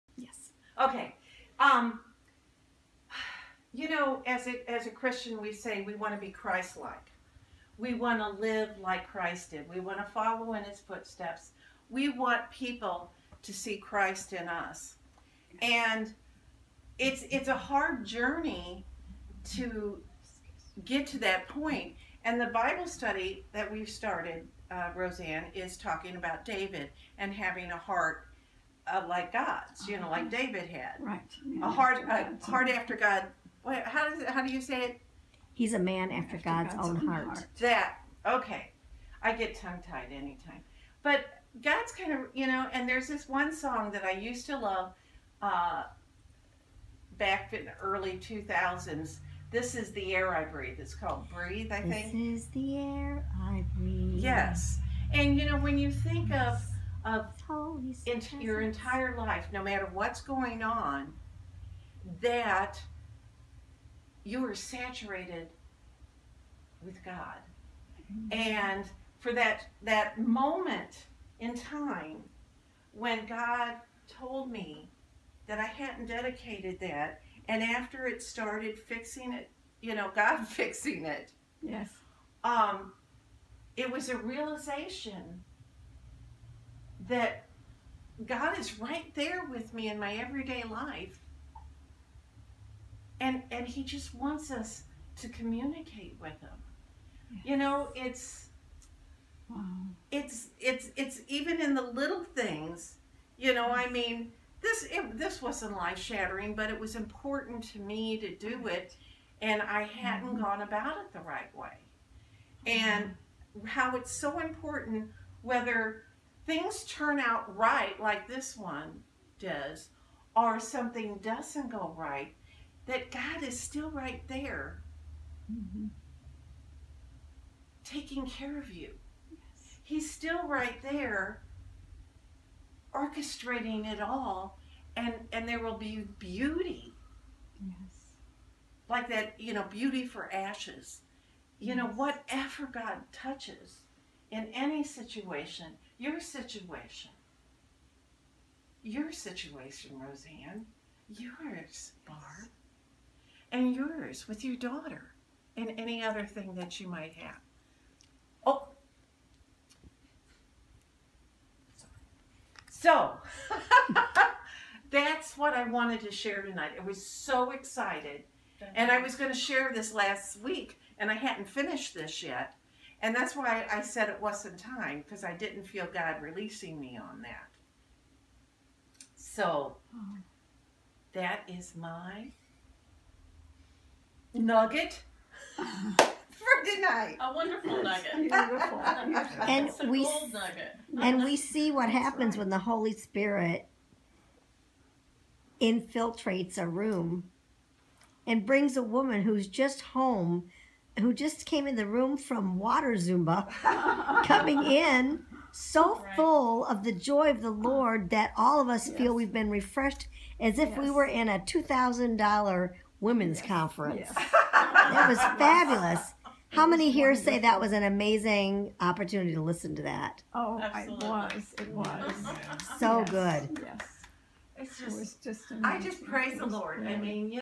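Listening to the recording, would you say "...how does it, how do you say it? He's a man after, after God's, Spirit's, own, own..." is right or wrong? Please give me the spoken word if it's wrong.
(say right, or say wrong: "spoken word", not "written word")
wrong: "God", not "Spirit".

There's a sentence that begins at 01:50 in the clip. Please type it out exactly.
gone about it the right way.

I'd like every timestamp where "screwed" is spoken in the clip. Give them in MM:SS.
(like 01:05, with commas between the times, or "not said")
not said.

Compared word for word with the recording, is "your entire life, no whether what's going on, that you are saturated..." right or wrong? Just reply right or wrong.
wrong.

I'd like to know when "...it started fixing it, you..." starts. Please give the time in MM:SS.
01:18.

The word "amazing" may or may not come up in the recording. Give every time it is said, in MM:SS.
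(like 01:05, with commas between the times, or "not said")
03:37, 03:45.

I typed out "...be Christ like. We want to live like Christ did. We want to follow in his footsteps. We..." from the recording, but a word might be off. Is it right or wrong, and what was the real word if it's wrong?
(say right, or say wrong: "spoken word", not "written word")
right.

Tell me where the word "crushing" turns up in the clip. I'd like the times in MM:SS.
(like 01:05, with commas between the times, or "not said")
not said.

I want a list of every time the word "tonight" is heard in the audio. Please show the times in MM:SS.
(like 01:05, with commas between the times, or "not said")
02:46, 03:06.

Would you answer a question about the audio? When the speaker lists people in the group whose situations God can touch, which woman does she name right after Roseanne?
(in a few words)
Barb.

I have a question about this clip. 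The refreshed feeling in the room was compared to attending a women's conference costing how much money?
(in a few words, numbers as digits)
$2,000.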